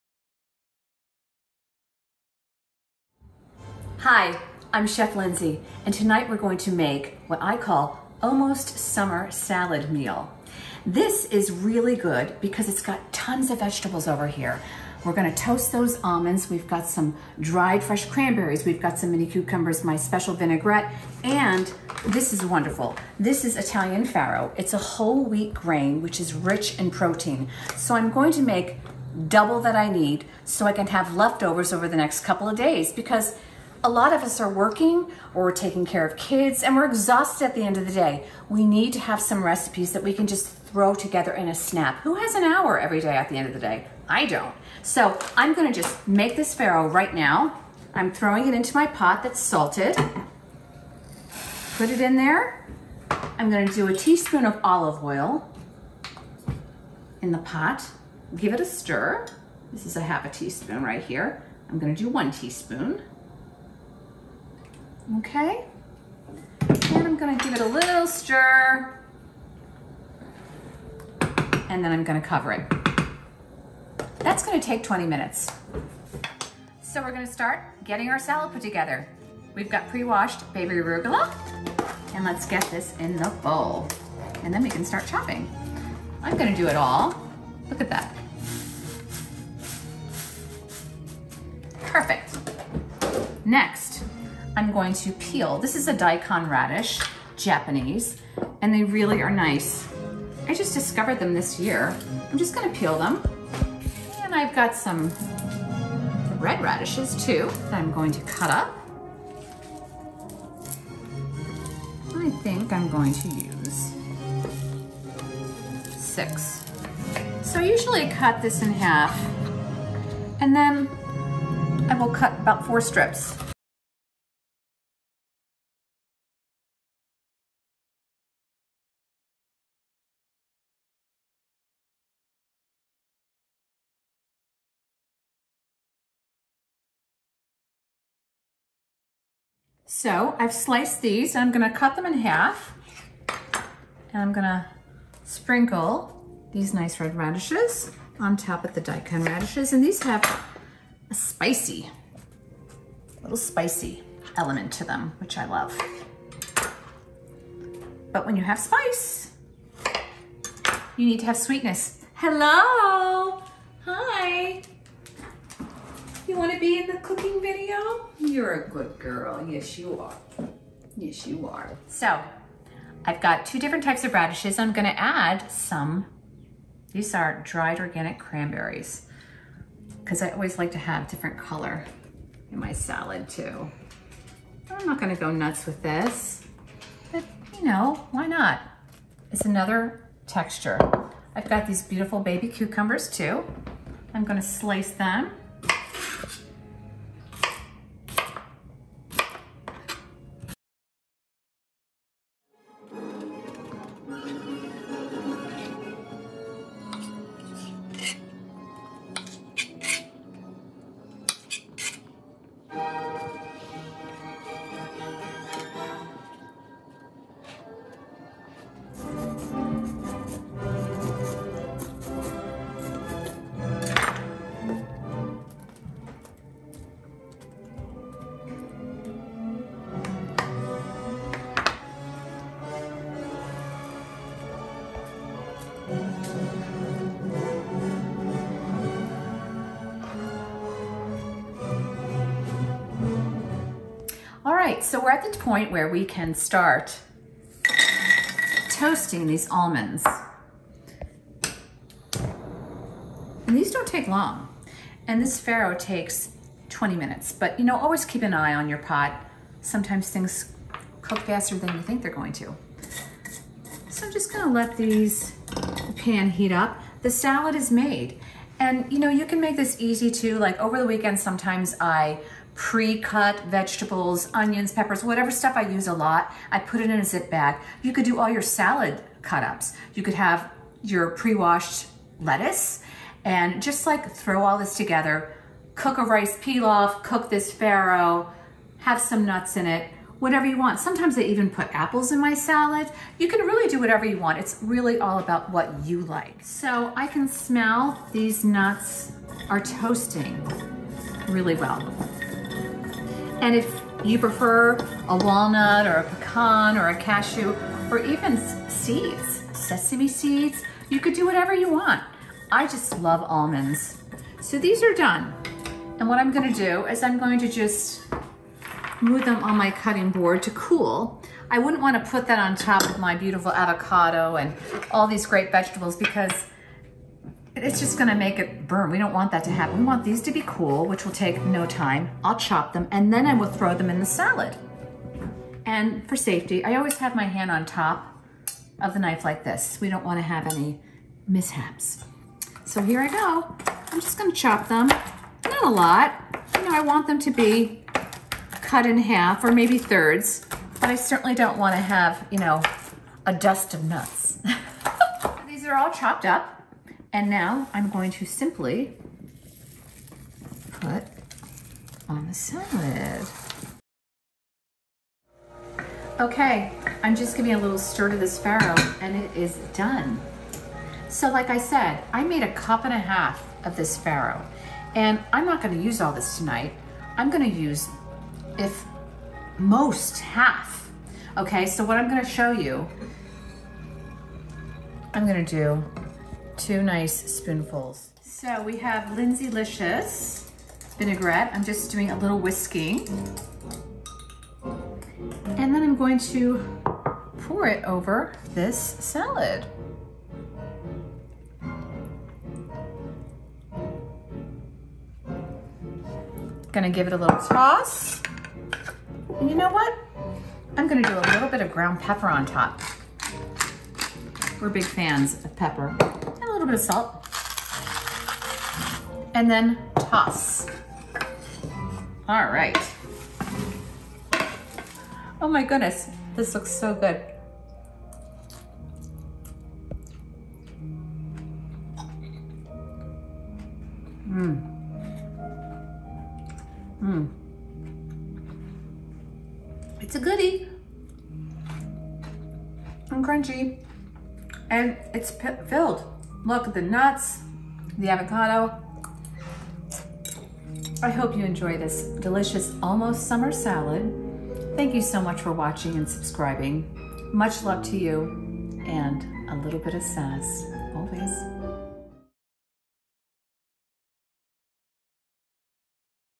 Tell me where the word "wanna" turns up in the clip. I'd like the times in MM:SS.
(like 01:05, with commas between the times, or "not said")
05:21, 05:40, 05:51.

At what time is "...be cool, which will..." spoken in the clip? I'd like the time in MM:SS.
05:30.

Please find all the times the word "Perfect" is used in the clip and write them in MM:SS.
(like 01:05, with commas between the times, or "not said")
01:31.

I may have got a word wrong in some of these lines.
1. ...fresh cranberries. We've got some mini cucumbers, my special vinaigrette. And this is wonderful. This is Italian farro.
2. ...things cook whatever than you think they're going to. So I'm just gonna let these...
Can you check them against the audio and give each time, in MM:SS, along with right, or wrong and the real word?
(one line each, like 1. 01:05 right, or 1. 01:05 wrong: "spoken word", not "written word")
1. 00:17 right
2. 04:20 wrong: "faster", not "whatever".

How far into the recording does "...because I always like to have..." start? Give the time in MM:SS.
02:59.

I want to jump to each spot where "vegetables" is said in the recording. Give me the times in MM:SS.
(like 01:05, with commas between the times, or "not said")
00:13, 04:33, 05:25.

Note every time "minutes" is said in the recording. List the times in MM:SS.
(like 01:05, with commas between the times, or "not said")
01:15, 04:16.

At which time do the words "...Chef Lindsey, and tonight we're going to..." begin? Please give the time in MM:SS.
00:04.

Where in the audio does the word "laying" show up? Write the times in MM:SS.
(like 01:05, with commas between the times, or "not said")
not said.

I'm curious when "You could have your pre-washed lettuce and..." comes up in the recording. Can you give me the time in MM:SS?
04:39.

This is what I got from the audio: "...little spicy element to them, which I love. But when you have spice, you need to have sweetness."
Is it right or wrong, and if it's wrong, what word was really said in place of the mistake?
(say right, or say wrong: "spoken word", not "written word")
right.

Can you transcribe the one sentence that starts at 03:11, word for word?
I've got these beautiful baby cucumbers too.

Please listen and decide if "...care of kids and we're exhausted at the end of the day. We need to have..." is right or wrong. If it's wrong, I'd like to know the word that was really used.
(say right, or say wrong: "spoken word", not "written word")
right.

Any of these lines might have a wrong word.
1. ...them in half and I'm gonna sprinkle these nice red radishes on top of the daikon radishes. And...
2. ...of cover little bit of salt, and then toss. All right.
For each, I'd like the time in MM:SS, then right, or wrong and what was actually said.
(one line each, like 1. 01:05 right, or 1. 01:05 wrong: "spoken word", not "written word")
1. 02:21 right
2. 06:55 wrong: "pepper", not "cover".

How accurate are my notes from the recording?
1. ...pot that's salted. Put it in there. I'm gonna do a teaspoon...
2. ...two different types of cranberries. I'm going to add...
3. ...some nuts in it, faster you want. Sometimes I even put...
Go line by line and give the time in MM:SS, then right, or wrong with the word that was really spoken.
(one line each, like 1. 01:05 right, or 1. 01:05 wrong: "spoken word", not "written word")
1. 00:48 right
2. 02:53 wrong: "radishes", not "cranberries"
3. 04:48 wrong: "whatever", not "faster".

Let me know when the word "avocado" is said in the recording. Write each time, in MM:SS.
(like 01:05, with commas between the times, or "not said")
05:23, 07:28.